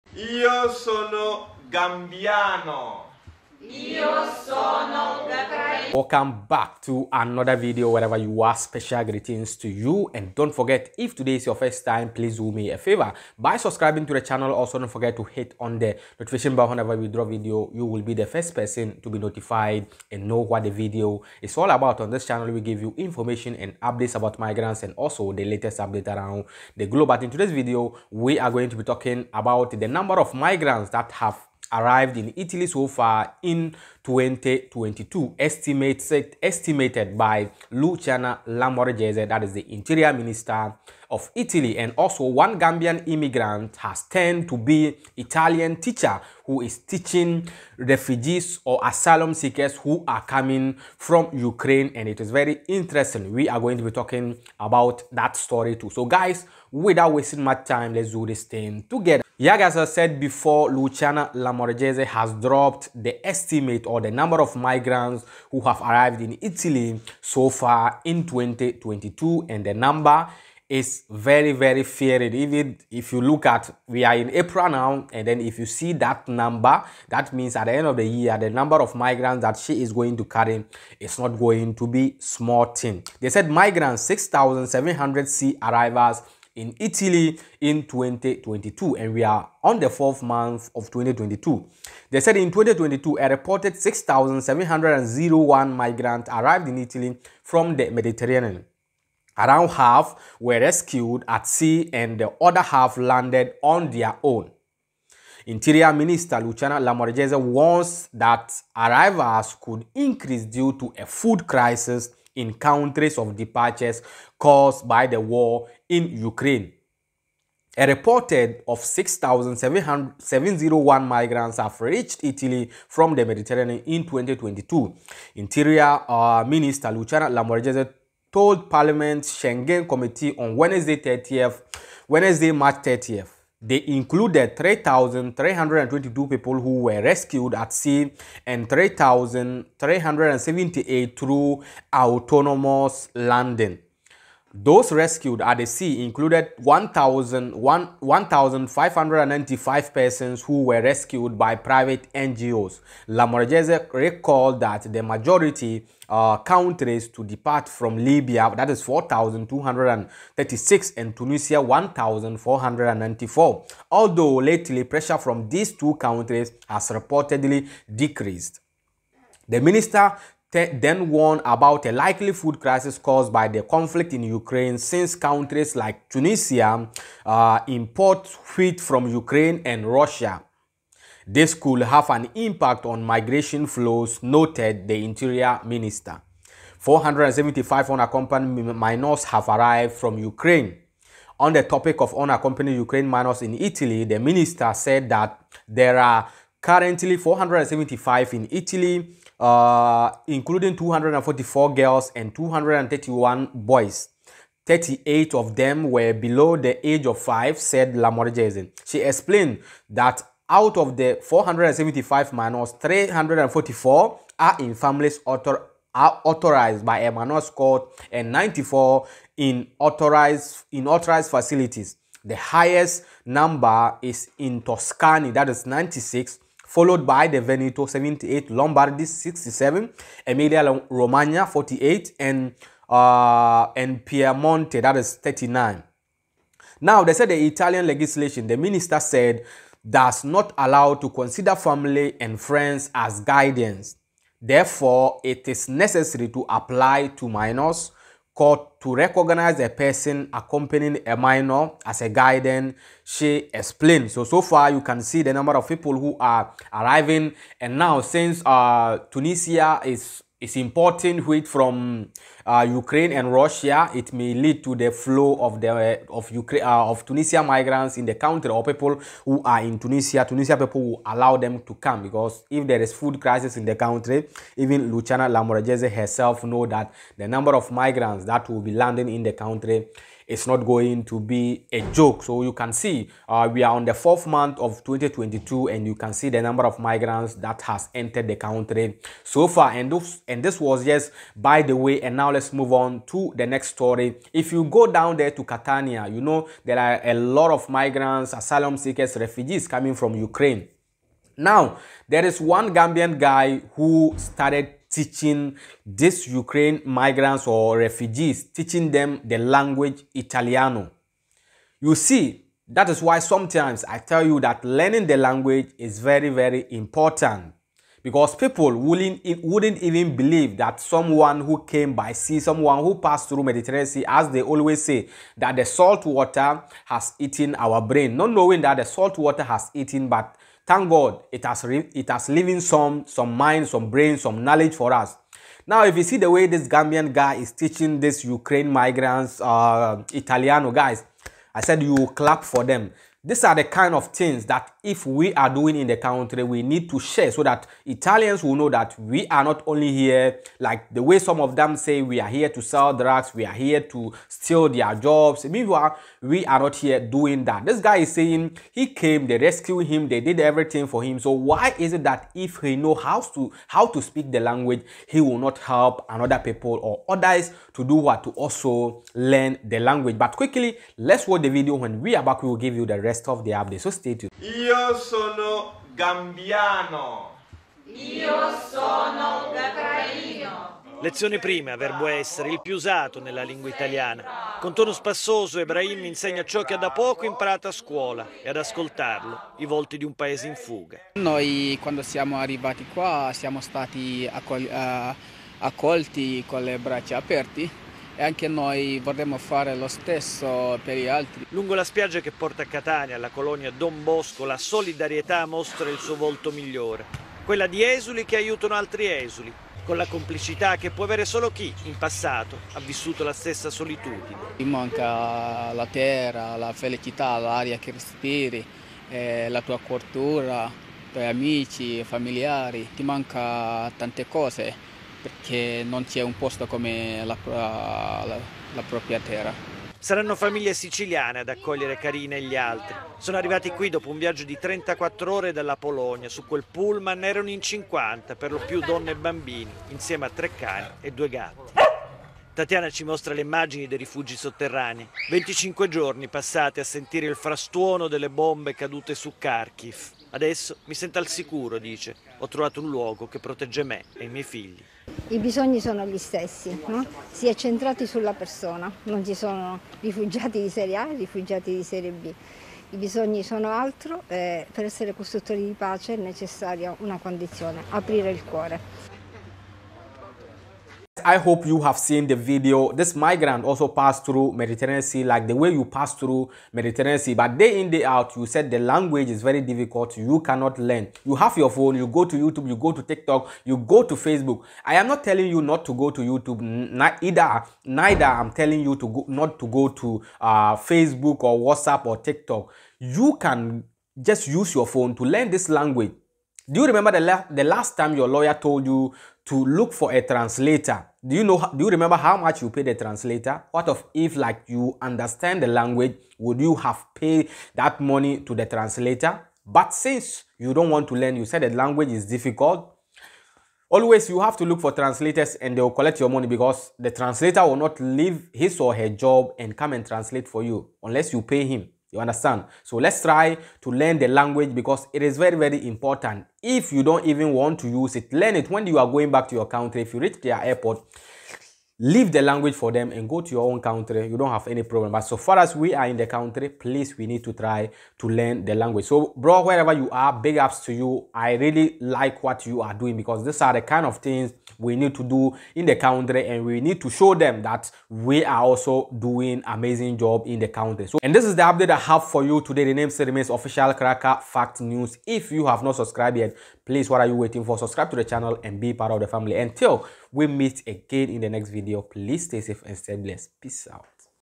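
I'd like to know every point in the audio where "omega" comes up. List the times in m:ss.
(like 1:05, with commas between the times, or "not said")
not said.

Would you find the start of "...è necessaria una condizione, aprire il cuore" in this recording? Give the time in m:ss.
7:46.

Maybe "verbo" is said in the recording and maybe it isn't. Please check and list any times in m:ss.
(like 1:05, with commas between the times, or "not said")
6:21.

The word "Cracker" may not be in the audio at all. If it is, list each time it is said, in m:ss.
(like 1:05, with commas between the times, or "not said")
9:13.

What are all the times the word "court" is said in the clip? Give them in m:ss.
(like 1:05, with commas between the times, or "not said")
3:37, 4:08.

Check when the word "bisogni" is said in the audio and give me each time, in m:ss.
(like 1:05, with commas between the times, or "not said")
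7:35, 7:42.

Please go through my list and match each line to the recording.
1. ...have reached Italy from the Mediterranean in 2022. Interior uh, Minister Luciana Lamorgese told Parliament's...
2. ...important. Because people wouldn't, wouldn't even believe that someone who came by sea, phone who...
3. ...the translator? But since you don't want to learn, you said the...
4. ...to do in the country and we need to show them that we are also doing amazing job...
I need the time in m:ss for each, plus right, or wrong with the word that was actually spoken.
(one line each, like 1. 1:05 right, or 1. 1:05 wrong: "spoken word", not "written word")
1. 2:01 right
2. 5:16 wrong: "someone", not "phone"
3. 8:28 right
4. 9:05 right.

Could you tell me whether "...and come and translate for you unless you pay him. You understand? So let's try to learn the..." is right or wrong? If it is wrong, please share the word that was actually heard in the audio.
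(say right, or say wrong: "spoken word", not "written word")
right.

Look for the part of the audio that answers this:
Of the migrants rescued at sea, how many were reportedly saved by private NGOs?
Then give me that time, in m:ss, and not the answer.
2:26.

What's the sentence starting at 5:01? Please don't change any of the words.
Now, there is one Gambian guy who started teaching these Ukraine migrants or refugees, teaching them the language Italiano.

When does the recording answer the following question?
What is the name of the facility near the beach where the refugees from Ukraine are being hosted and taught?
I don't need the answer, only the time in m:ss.
6:43.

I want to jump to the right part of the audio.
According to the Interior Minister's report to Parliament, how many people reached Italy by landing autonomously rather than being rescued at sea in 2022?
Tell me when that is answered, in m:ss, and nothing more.
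2:18.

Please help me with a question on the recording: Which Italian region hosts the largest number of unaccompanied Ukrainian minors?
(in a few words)
Tuscany.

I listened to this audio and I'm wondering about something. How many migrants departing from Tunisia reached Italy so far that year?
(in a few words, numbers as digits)
1,494.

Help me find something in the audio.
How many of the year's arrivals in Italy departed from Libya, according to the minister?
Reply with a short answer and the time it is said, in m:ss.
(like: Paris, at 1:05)
4,236, at 2:38.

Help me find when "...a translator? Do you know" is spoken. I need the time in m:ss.
8:20.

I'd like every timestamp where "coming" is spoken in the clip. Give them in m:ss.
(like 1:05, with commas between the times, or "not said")
0:50, 4:59.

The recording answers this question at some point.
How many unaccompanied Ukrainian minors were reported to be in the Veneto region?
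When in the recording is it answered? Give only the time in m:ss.
3:47.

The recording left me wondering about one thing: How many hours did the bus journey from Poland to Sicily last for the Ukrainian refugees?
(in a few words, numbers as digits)
34.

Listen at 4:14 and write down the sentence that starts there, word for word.
So, so far you can see the number of people who are arriving.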